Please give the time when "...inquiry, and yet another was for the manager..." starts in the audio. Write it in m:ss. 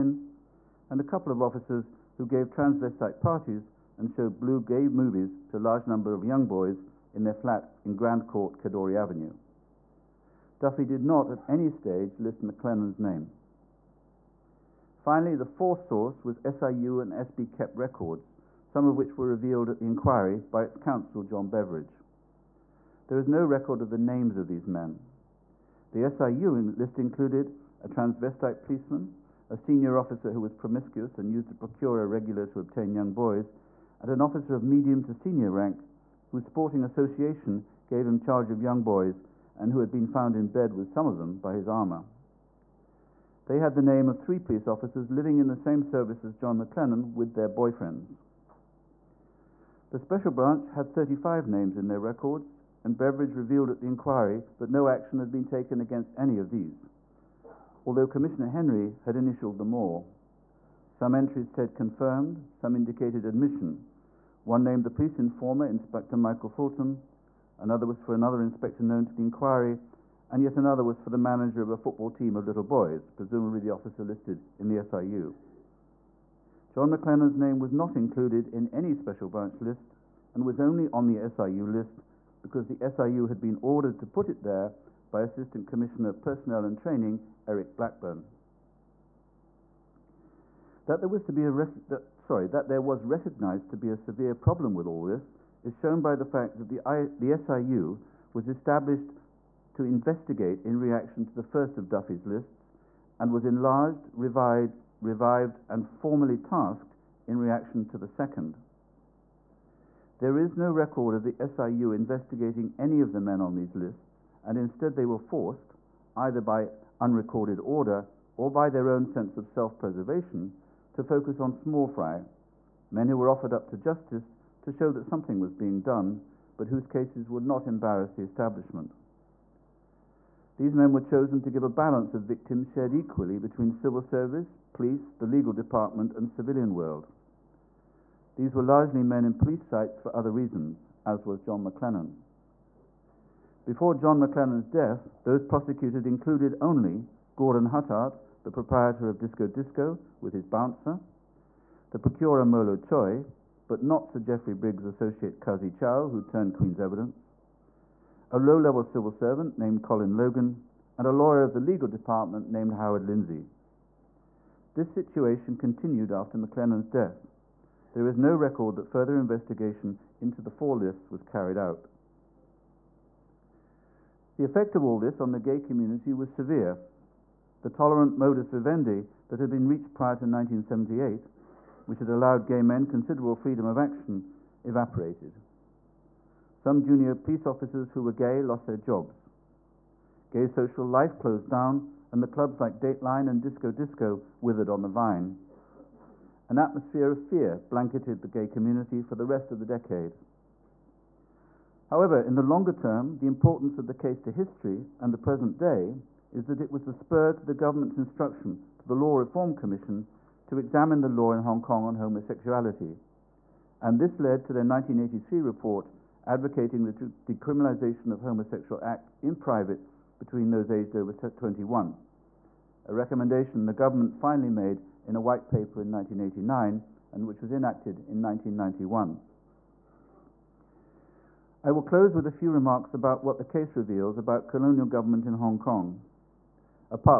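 1:09.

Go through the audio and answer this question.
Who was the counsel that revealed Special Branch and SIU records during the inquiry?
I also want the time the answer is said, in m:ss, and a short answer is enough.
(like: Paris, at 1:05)
John Beveridge, at 0:21.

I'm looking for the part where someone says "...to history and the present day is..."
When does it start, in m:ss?
3:24.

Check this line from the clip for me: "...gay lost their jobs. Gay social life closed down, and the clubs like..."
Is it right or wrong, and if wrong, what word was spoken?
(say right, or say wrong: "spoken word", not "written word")
right.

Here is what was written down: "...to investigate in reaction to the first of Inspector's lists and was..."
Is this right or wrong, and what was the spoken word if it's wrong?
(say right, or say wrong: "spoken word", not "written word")
wrong: "Duffy", not "Inspector".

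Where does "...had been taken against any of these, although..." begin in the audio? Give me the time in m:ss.
0:55.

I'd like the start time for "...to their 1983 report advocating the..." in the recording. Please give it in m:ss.
3:34.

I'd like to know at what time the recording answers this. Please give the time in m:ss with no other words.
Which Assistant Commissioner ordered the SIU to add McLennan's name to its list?
1:27.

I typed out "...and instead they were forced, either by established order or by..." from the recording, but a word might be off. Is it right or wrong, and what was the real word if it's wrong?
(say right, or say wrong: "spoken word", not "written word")
wrong: "unrecorded", not "established".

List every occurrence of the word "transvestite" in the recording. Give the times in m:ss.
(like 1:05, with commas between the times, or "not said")
0:02, 0:27.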